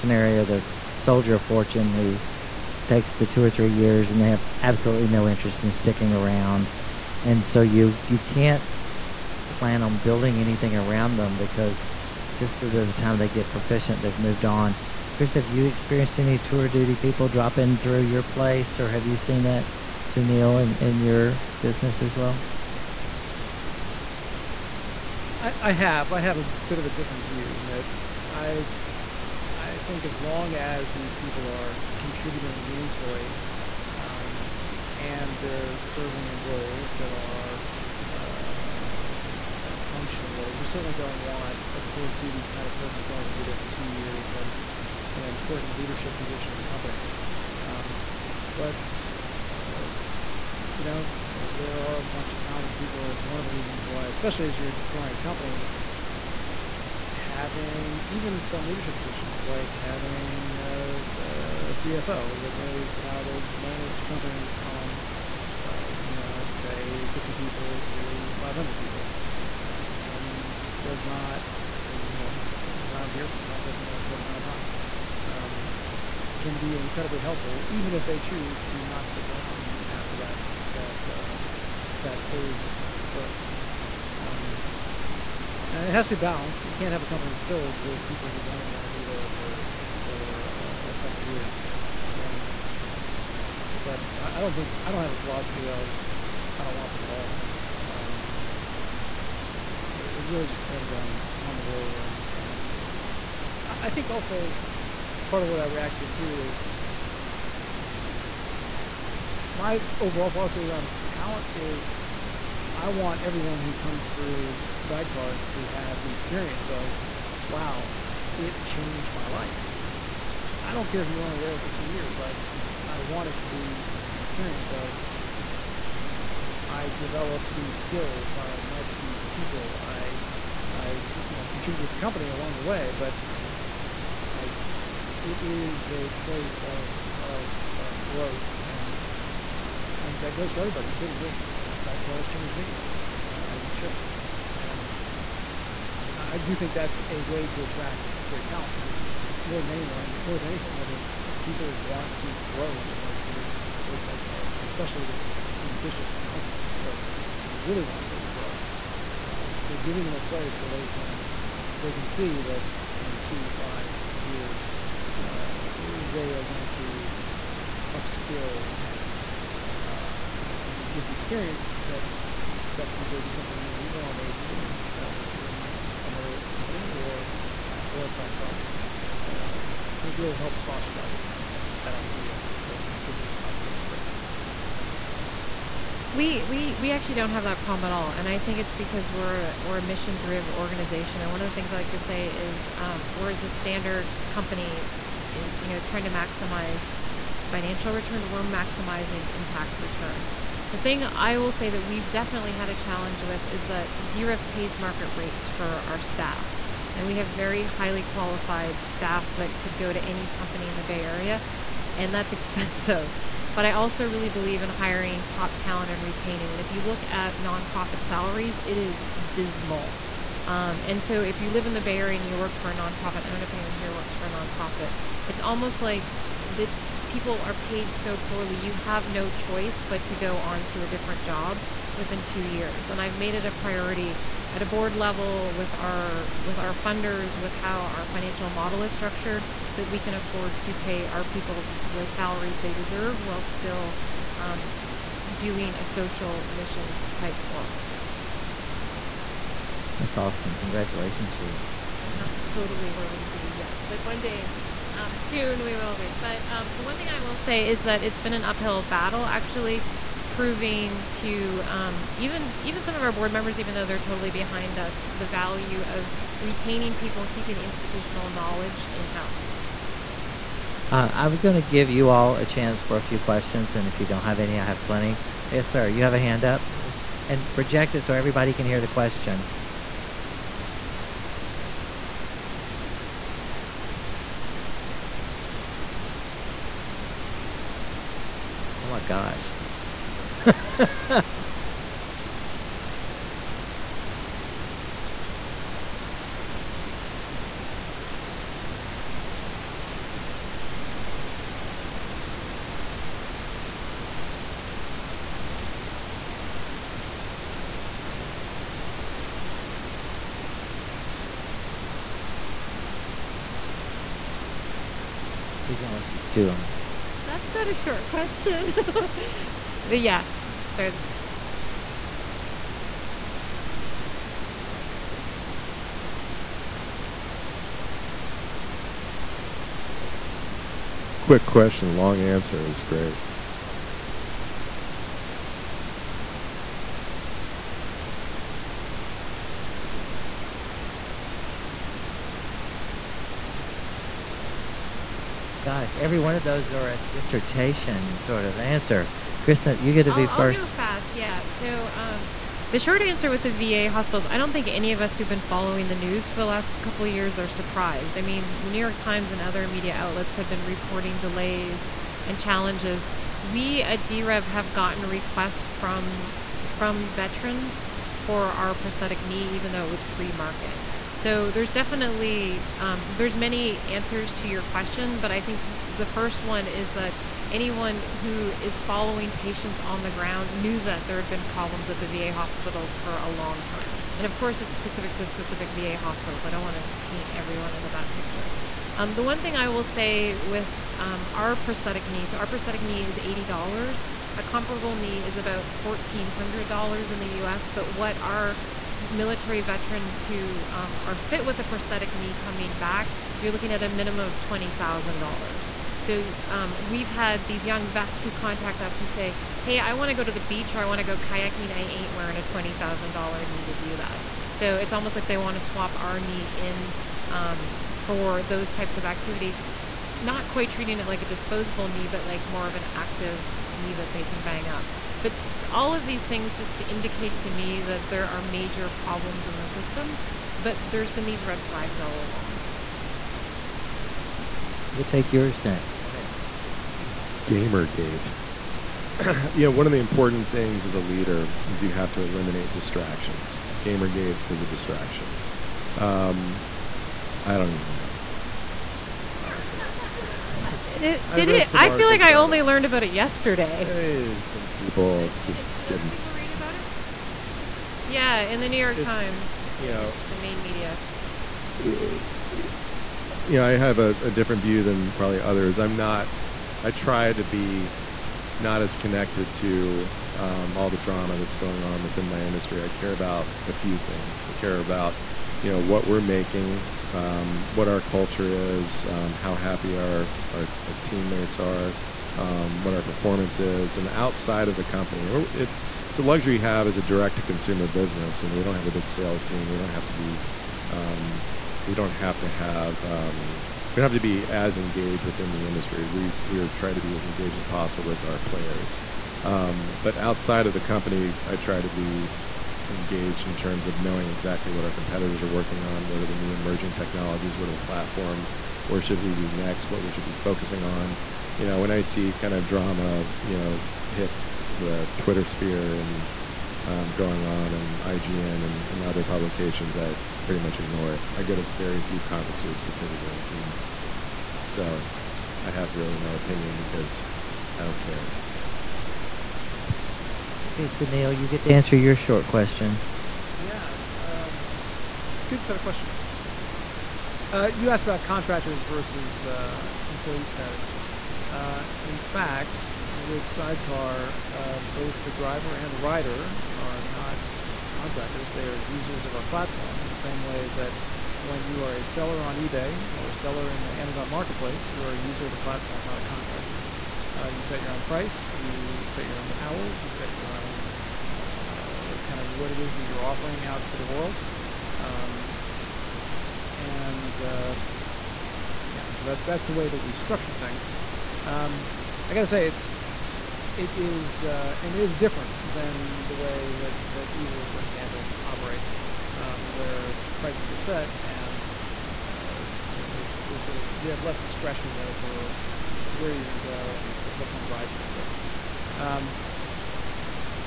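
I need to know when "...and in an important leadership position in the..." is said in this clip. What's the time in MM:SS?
00:44.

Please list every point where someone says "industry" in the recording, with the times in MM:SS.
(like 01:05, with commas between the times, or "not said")
07:52, 08:15.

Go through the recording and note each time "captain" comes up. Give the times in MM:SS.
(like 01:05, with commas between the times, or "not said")
not said.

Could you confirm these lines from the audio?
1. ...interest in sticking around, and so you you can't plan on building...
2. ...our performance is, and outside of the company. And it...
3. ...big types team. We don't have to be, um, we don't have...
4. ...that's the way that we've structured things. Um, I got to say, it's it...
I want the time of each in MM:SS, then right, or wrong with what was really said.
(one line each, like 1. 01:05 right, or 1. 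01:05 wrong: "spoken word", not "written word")
1. 00:05 right
2. 08:02 right
3. 08:08 wrong: "sales", not "types"
4. 09:29 right.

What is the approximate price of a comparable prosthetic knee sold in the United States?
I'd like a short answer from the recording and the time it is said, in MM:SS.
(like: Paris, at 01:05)
$1,400, at 06:35.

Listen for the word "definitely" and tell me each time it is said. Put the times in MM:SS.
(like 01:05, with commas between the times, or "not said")
03:22, 06:11.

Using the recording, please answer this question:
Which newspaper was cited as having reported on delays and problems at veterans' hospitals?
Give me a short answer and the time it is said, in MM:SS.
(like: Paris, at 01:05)
The New York Times, at 05:58.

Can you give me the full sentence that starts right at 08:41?
I go to very few conferences because of this.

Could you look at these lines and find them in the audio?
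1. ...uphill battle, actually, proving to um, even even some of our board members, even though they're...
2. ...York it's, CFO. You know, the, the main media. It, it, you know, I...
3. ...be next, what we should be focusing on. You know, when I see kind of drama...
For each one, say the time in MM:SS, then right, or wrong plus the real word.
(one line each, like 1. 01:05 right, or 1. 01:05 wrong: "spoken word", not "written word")
1. 04:18 right
2. 07:38 wrong: "Times", not "CFO"
3. 08:29 right.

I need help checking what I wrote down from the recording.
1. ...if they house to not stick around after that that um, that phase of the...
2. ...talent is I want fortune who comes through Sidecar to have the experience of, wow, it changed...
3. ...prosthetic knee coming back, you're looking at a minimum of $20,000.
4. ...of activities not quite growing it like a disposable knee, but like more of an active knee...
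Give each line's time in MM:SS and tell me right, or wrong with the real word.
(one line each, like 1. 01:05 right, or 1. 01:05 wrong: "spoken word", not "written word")
1. 01:17 wrong: "choose", not "house"
2. 01:51 wrong: "everyone", not "fortune"
3. 06:41 right
4. 06:58 wrong: "treating", not "growing".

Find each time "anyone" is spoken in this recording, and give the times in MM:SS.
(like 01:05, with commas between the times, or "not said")
02:29, 03:43, 06:17.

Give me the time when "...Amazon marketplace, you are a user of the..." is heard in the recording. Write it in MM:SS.
09:13.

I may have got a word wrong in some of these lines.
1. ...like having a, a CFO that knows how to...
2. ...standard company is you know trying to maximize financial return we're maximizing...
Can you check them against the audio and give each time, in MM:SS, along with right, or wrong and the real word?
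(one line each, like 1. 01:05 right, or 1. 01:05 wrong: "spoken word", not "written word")
1. 00:59 right
2. 03:13 right.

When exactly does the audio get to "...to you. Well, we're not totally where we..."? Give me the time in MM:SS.
04:11.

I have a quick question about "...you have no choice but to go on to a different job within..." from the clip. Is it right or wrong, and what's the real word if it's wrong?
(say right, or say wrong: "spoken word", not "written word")
right.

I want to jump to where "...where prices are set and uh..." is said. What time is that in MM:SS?
09:39.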